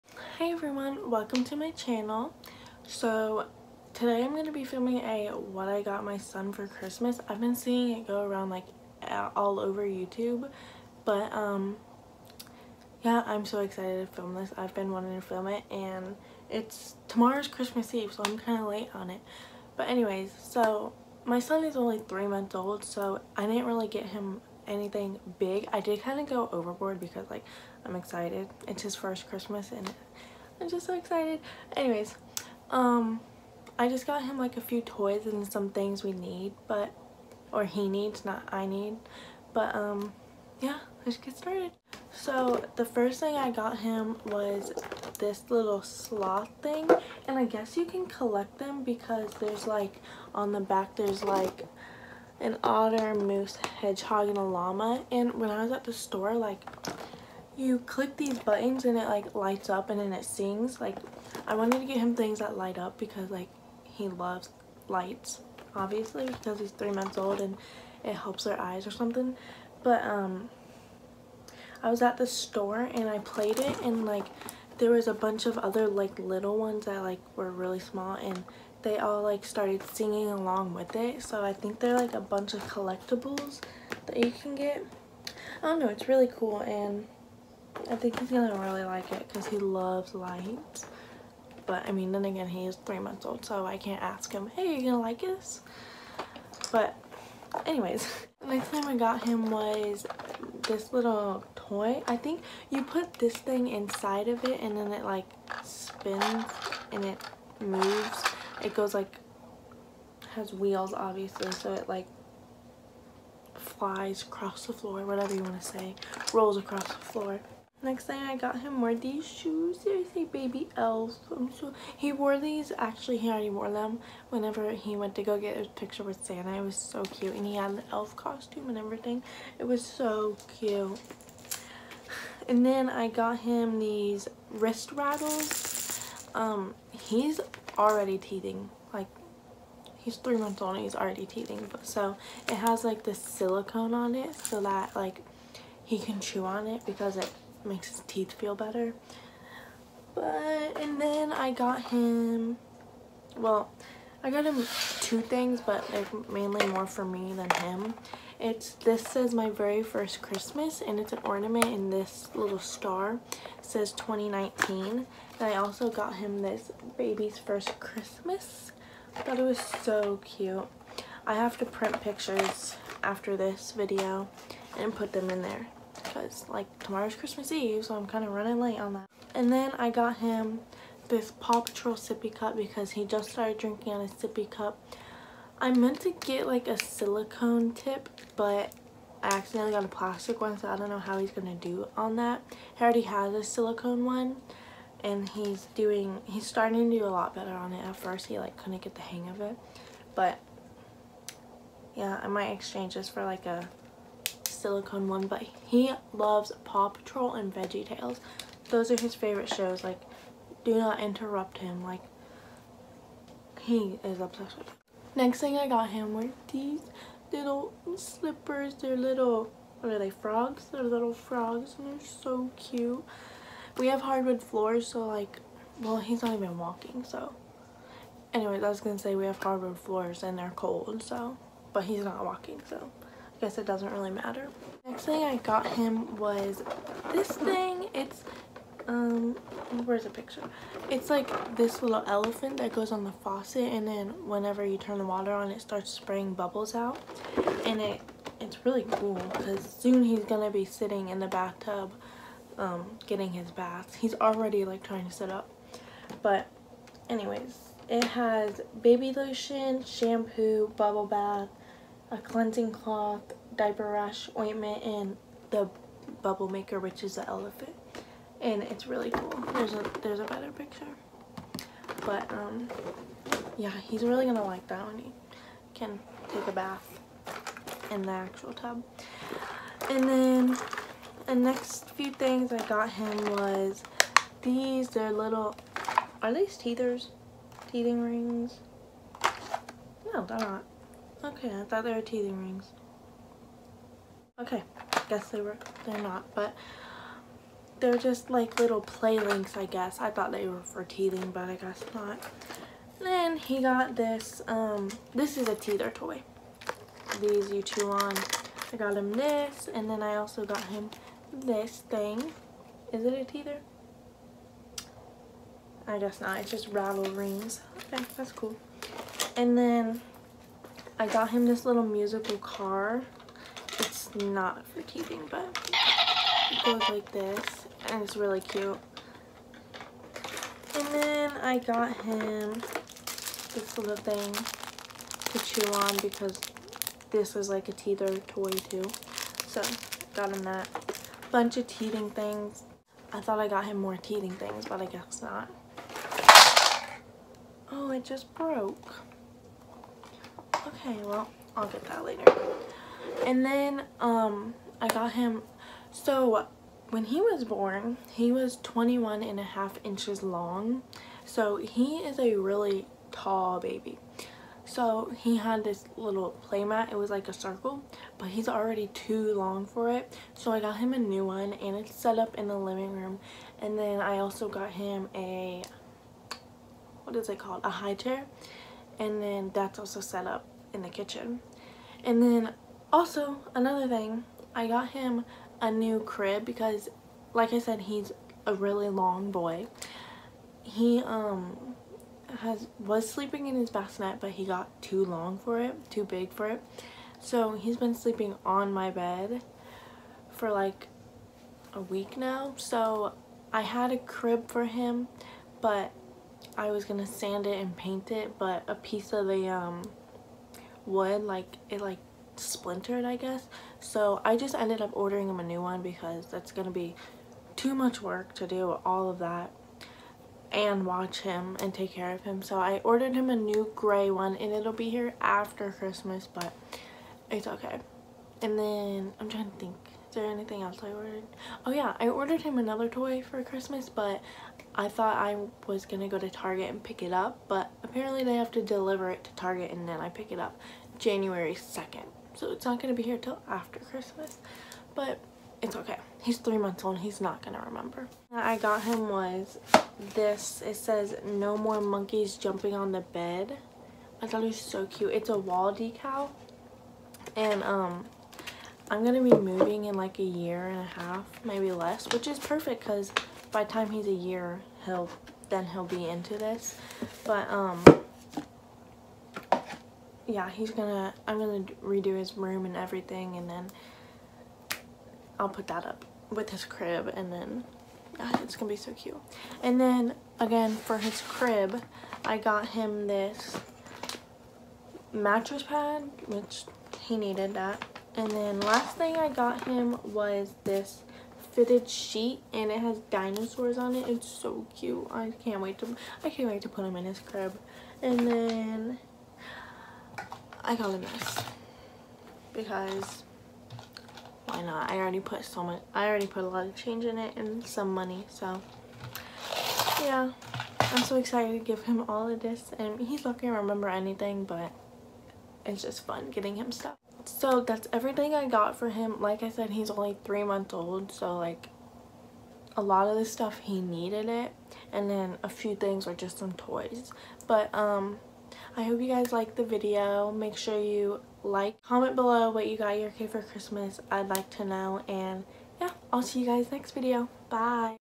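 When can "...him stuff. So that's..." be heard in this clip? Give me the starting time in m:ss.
8:36.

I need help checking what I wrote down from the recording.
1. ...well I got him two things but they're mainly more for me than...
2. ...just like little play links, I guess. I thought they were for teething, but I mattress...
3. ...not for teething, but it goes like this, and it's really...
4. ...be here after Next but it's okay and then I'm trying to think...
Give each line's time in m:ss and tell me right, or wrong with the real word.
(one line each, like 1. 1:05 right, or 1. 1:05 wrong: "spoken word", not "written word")
1. 2:33 right
2. 4:57 wrong: "guess", not "mattress"
3. 5:24 right
4. 7:04 wrong: "Christmas", not "Next".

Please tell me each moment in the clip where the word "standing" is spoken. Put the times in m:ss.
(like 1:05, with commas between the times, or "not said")
not said.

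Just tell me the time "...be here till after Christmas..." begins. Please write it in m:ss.
7:22.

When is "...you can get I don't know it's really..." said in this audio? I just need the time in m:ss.
1:24.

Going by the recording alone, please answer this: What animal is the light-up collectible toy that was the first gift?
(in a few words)
Sloth.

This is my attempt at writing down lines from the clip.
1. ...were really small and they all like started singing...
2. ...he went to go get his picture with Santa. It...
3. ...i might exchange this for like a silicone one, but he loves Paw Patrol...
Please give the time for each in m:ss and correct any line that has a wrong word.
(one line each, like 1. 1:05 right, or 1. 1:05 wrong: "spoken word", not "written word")
1. 1:17 right
2. 2:04 right
3. 3:22 right.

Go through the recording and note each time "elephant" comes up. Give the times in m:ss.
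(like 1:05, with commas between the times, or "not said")
4:02, 4:27.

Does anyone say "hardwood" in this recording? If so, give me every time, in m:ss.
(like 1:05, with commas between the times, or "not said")
3:44, 3:49.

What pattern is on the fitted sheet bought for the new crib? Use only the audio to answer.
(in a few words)
Dinosaurs.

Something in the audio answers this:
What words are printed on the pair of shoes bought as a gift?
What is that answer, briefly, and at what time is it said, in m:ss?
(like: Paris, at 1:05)
Baby elves, at 2:00.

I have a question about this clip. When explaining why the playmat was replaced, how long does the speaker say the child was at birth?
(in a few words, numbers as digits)
21.5 inches.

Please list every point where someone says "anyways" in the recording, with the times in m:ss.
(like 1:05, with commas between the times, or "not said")
0:19, 0:31, 1:37, 3:48, 4:17.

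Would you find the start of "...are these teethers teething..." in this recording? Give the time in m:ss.
4:46.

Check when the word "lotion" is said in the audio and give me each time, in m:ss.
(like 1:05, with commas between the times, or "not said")
4:19.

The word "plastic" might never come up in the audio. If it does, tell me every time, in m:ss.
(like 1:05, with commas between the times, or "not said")
3:09.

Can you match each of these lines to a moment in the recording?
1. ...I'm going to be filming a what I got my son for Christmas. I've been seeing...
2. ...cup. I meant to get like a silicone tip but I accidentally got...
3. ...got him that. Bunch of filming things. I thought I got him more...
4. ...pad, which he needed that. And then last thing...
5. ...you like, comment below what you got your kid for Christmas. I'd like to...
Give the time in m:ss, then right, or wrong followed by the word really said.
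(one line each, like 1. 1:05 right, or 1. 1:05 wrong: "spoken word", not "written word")
1. 0:04 right
2. 3:04 right
3. 5:40 wrong: "teething", not "filming"
4. 8:05 right
5. 8:50 right.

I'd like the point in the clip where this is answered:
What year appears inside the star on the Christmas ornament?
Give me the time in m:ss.
2:43.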